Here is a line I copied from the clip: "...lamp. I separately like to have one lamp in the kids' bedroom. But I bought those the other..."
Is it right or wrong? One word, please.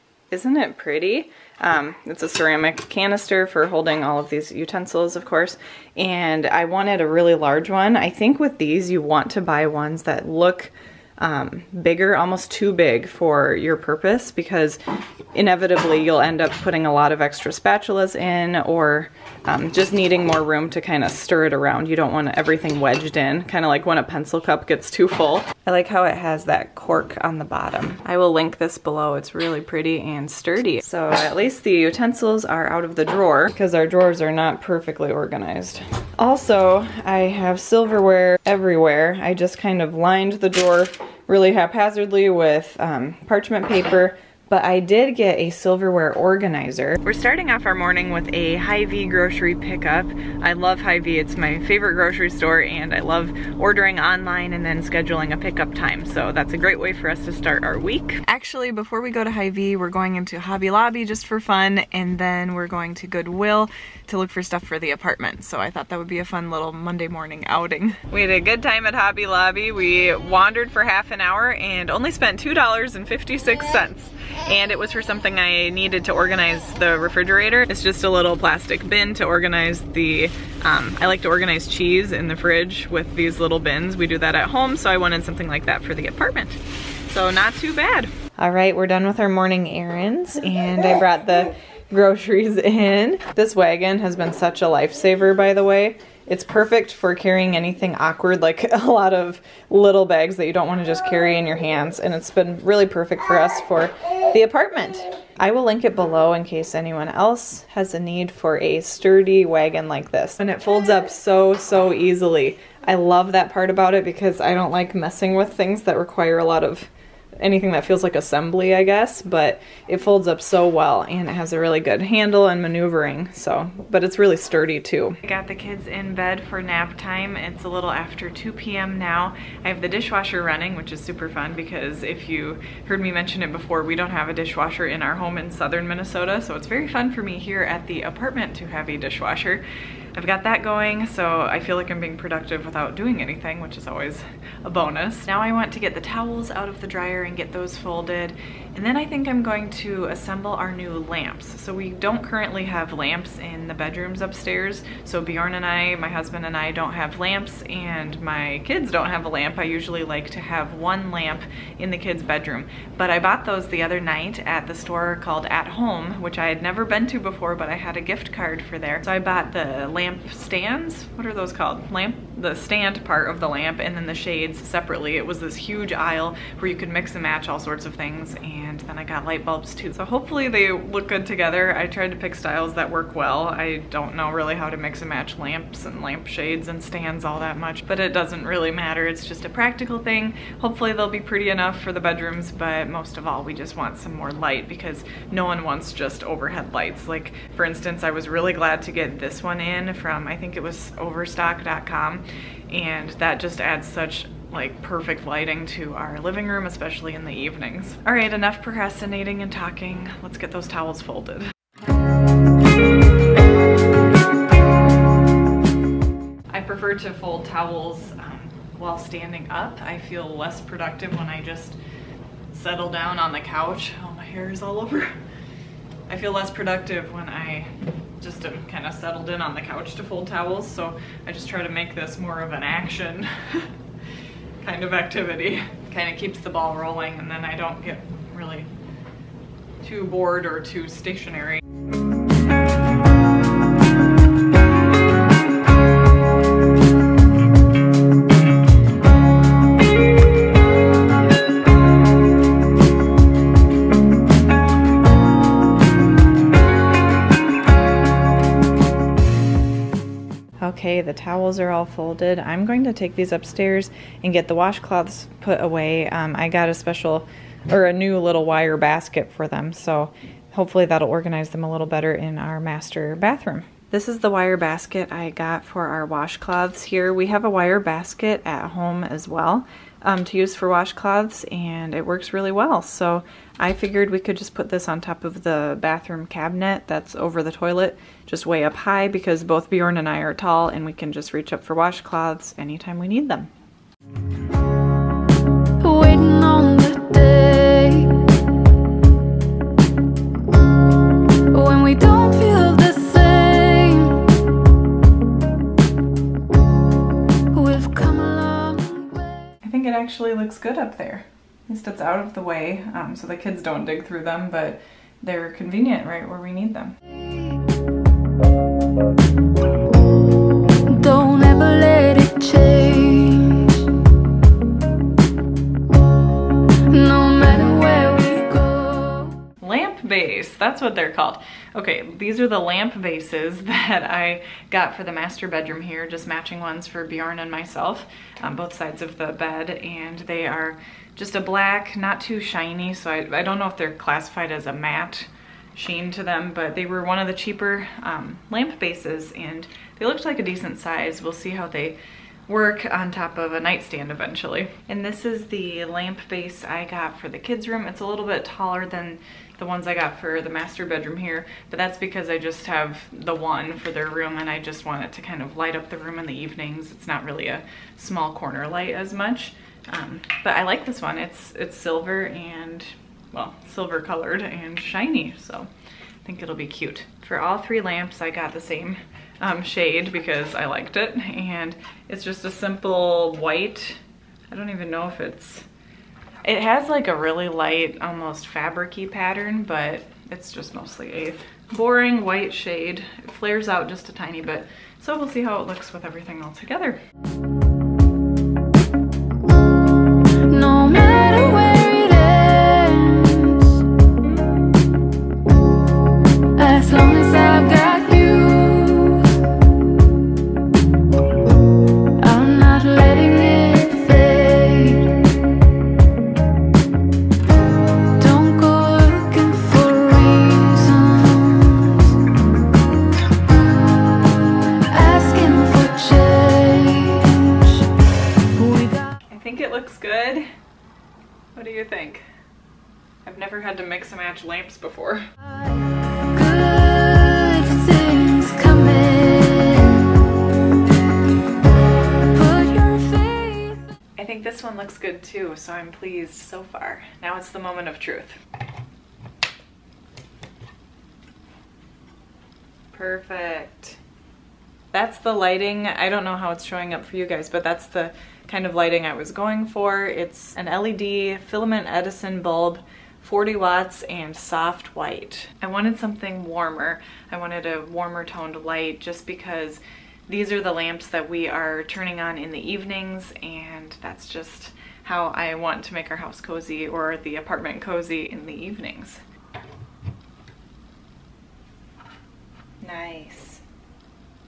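wrong.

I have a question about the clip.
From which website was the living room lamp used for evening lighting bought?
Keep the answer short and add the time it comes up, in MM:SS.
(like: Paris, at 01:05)
overstock.com, at 03:20.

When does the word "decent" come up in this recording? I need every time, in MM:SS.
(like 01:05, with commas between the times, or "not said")
05:50.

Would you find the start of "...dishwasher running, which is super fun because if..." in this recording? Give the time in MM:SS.
02:09.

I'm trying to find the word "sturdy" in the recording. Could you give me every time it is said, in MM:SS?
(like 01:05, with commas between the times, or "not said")
00:30, 01:48, 02:04.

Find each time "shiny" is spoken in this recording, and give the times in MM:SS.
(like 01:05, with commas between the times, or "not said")
05:42, 06:14.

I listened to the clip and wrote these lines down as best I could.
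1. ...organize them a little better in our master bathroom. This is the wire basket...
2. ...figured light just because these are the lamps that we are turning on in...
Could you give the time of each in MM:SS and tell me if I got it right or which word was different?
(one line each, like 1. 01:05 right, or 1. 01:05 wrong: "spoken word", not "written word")
1. 04:31 right
2. 07:48 wrong: "toned", not "figured".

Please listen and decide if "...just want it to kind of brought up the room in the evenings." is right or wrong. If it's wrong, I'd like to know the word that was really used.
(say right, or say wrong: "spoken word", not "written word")
wrong: "light", not "brought".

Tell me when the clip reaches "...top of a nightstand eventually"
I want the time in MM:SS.
05:53.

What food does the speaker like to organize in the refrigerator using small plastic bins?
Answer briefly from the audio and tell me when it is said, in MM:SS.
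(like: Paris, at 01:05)
Cheese, at 01:21.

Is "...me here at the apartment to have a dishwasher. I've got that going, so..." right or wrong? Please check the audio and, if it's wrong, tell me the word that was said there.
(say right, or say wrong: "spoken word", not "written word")
right.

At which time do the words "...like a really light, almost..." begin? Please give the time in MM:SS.
06:26.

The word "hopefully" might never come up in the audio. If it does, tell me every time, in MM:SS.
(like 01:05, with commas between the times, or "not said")
03:00, 03:10, 04:30.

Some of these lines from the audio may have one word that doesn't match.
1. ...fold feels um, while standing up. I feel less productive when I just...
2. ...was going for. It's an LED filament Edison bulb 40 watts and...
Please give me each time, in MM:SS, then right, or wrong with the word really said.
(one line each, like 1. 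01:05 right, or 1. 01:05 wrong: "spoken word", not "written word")
1. 03:37 wrong: "towels", not "feels"
2. 07:39 right.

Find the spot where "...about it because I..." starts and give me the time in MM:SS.
01:53.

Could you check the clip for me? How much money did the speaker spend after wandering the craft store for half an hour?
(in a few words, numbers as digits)
$2.56.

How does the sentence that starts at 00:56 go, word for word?
So that's a great way for us to start our week.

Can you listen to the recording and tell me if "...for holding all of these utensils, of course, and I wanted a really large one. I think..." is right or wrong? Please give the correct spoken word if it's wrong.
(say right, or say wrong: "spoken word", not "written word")
right.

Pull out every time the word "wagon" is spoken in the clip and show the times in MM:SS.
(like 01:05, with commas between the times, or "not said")
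01:33, 01:49.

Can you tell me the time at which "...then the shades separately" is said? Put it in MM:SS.
02:53.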